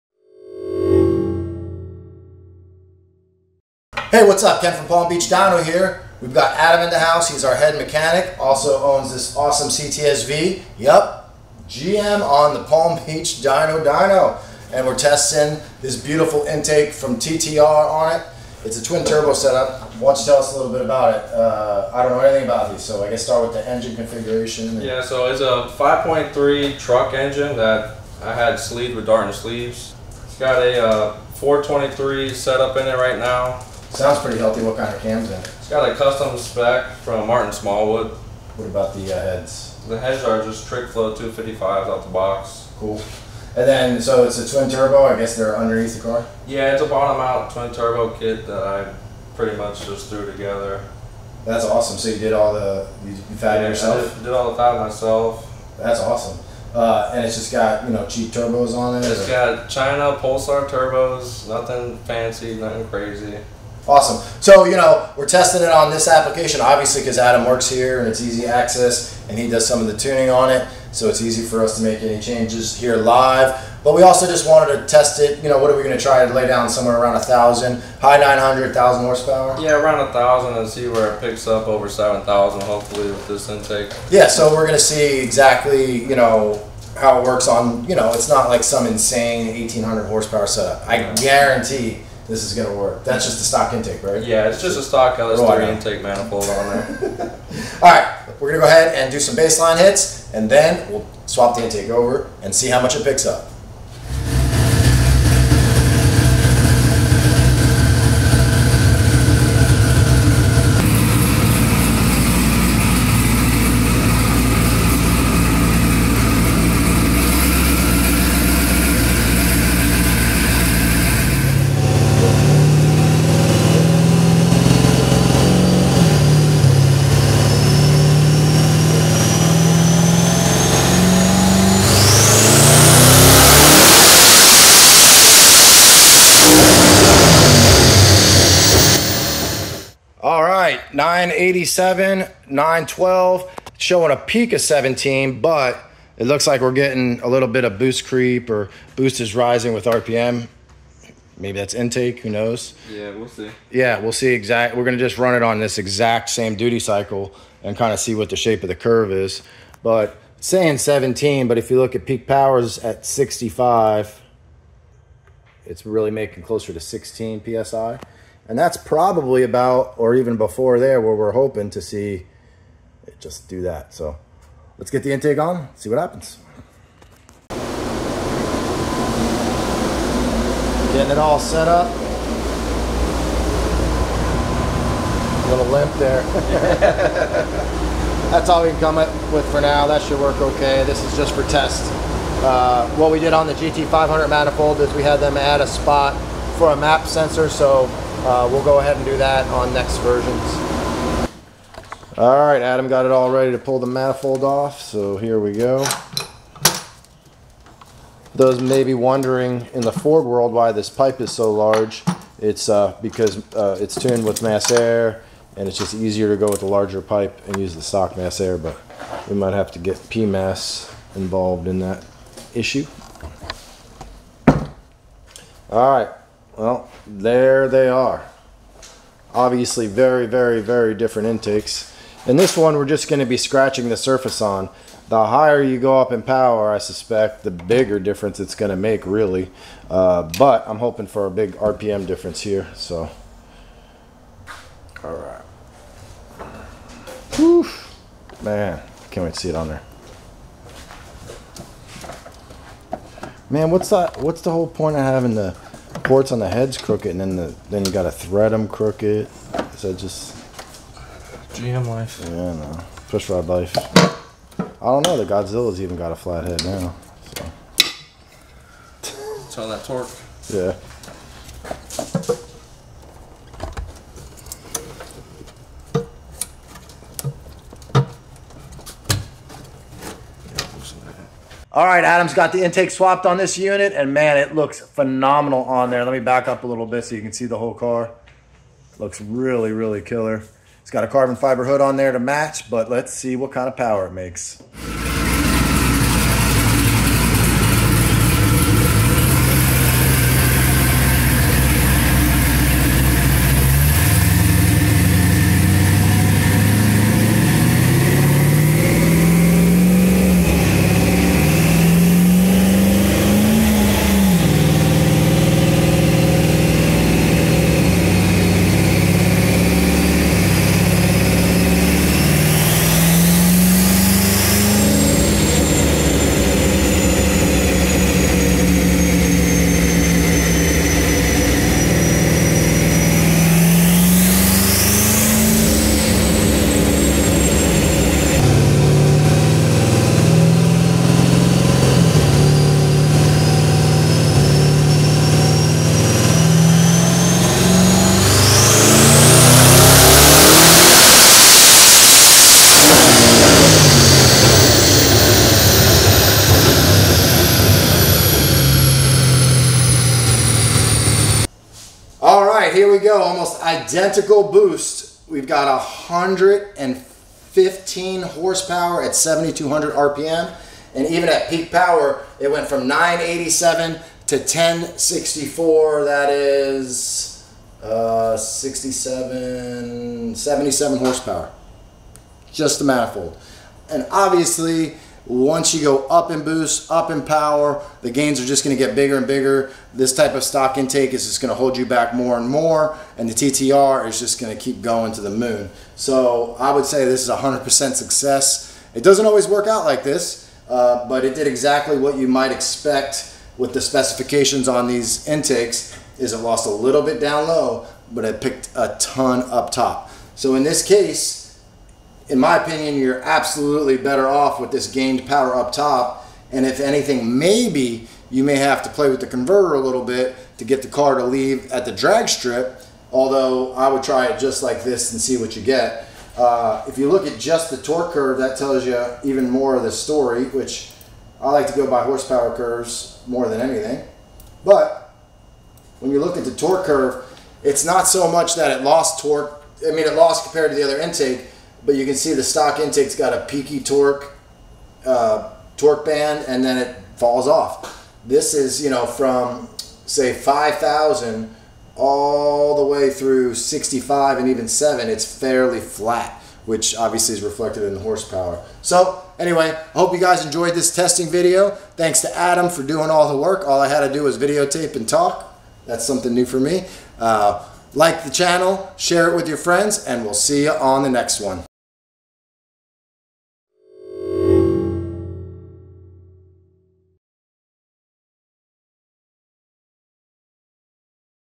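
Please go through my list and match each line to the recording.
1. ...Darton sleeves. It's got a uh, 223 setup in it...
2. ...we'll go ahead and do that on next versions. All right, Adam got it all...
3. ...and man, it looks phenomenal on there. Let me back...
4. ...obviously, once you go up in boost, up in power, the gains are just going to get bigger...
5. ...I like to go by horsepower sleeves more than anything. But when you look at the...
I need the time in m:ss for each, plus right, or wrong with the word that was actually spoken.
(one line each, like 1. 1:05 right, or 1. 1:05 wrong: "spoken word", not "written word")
1. 0:29 wrong: "423", not "223"
2. 3:18 right
3. 4:43 right
4. 6:24 right
5. 7:11 wrong: "curves", not "sleeves".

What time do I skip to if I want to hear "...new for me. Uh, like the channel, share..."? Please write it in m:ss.
7:46.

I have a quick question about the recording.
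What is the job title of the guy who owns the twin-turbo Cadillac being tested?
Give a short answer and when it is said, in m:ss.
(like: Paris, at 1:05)
Head mechanic, at 0:07.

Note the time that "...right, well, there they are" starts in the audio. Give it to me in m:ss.
3:45.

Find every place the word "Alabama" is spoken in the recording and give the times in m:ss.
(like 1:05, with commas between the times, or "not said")
not said.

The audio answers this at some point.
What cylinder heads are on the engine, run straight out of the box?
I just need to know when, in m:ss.
0:40.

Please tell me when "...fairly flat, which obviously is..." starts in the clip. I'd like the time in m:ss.
7:35.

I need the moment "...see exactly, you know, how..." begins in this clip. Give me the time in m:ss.
1:24.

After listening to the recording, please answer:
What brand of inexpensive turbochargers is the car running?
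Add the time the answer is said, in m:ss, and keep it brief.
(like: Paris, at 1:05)
China Pulsar, at 0:59.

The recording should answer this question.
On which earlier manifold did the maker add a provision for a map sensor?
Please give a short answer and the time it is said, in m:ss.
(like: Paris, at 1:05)
GT500, at 3:13.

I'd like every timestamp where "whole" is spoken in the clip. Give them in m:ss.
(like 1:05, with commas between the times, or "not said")
4:14, 4:47.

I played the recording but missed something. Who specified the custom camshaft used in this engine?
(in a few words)
Martin Smallwood.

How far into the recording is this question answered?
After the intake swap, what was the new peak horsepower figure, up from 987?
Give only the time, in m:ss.
6:14.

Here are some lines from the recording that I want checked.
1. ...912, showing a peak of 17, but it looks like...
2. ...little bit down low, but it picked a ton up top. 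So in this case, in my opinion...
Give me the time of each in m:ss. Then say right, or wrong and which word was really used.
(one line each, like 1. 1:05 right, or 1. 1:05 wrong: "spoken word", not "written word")
1. 2:22 right
2. 6:46 right.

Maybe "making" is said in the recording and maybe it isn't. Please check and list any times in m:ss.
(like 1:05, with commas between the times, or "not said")
2:46.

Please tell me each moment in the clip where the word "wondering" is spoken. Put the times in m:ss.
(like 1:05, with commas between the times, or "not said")
3:28.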